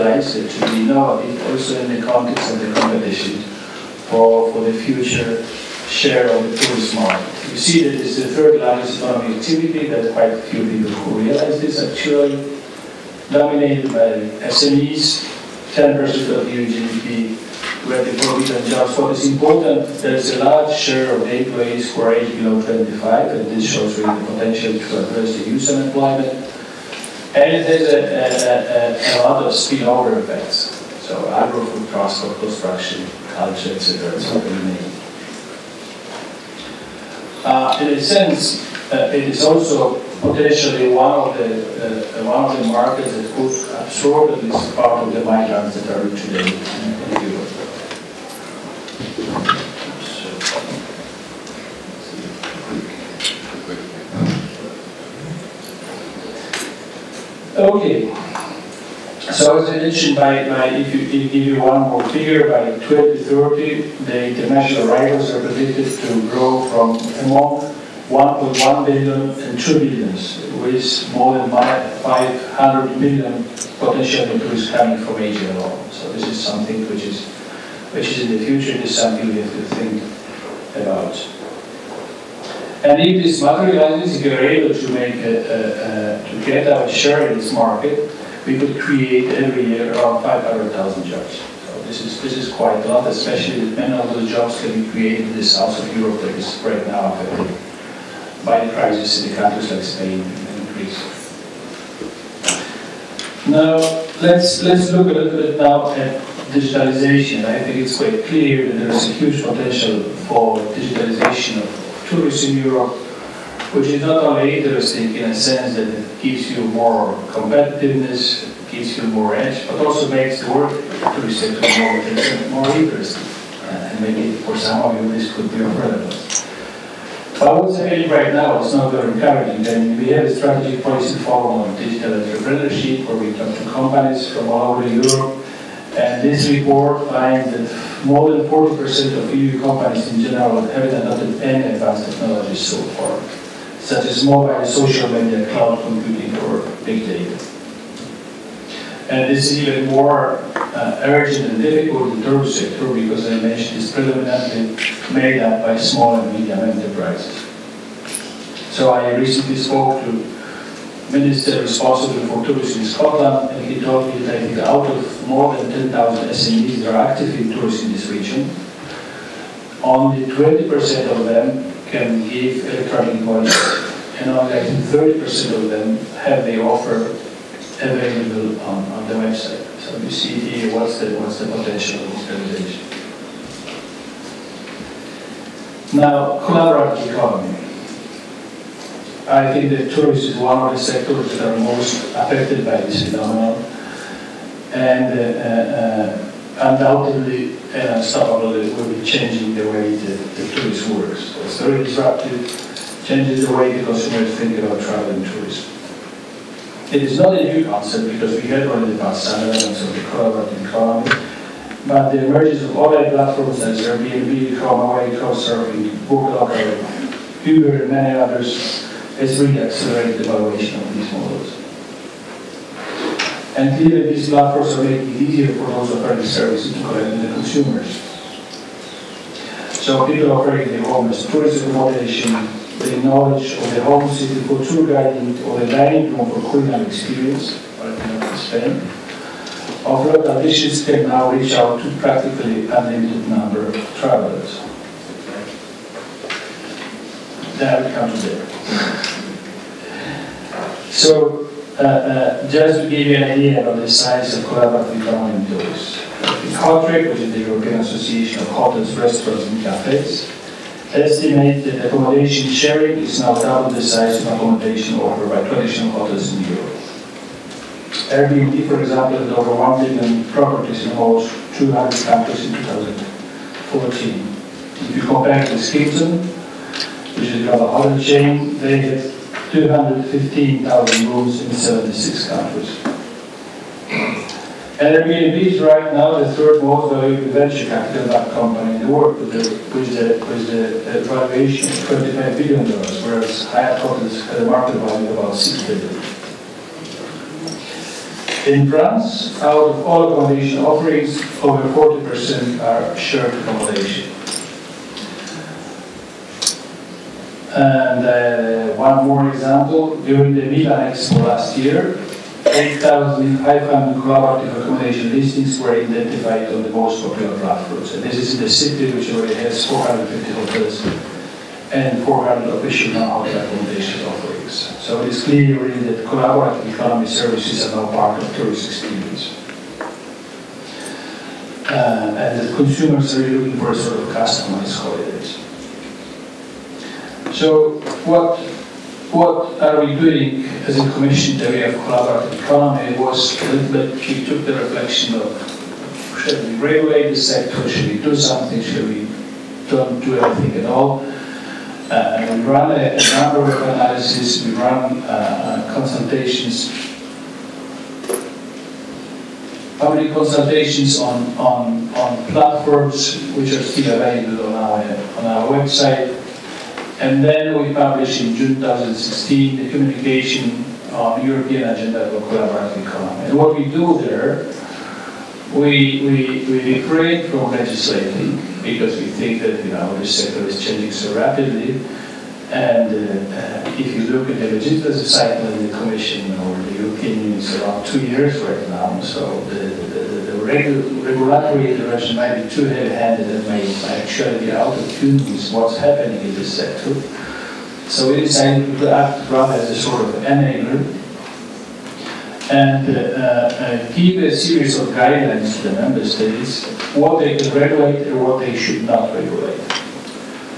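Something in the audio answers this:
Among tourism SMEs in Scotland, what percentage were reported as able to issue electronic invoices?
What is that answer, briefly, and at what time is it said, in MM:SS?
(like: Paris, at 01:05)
20%, at 02:49.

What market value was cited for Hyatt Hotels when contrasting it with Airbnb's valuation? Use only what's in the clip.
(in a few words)
6 billion.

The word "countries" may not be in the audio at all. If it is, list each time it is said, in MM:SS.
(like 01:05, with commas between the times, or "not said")
01:39, 04:32, 04:42.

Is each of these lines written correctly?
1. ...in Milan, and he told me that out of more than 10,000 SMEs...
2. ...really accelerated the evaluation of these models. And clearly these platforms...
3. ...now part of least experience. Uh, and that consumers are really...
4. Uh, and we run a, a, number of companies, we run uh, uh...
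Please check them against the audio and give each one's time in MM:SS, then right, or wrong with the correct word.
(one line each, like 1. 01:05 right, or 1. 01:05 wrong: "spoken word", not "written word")
1. 02:42 wrong: "Scotland", not "Milan"
2. 03:39 right
3. 05:27 wrong: "tourist", not "least"
4. 05:51 wrong: "analyses", not "companies".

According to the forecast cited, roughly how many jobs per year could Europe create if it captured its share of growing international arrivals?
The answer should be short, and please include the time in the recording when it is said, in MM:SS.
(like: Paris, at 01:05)
500,000, at 01:30.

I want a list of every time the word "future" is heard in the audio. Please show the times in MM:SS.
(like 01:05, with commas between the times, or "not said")
00:04, 01:18.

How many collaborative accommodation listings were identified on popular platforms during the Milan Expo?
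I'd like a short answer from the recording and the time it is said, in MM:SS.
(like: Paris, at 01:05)
8,500, at 05:12.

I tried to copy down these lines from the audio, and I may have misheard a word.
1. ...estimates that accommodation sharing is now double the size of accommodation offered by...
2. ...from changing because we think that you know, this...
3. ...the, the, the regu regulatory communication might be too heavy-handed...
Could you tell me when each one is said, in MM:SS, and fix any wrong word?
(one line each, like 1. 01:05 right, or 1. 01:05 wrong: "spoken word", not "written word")
1. 04:20 right
2. 06:17 wrong: "legislating", not "changing"
3. 06:29 wrong: "intervention", not "communication".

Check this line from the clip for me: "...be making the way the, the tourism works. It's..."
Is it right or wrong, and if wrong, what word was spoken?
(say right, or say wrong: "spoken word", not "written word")
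wrong: "changing", not "making".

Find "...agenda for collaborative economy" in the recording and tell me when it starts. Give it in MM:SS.
06:11.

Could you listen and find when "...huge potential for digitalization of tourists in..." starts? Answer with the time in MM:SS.
01:49.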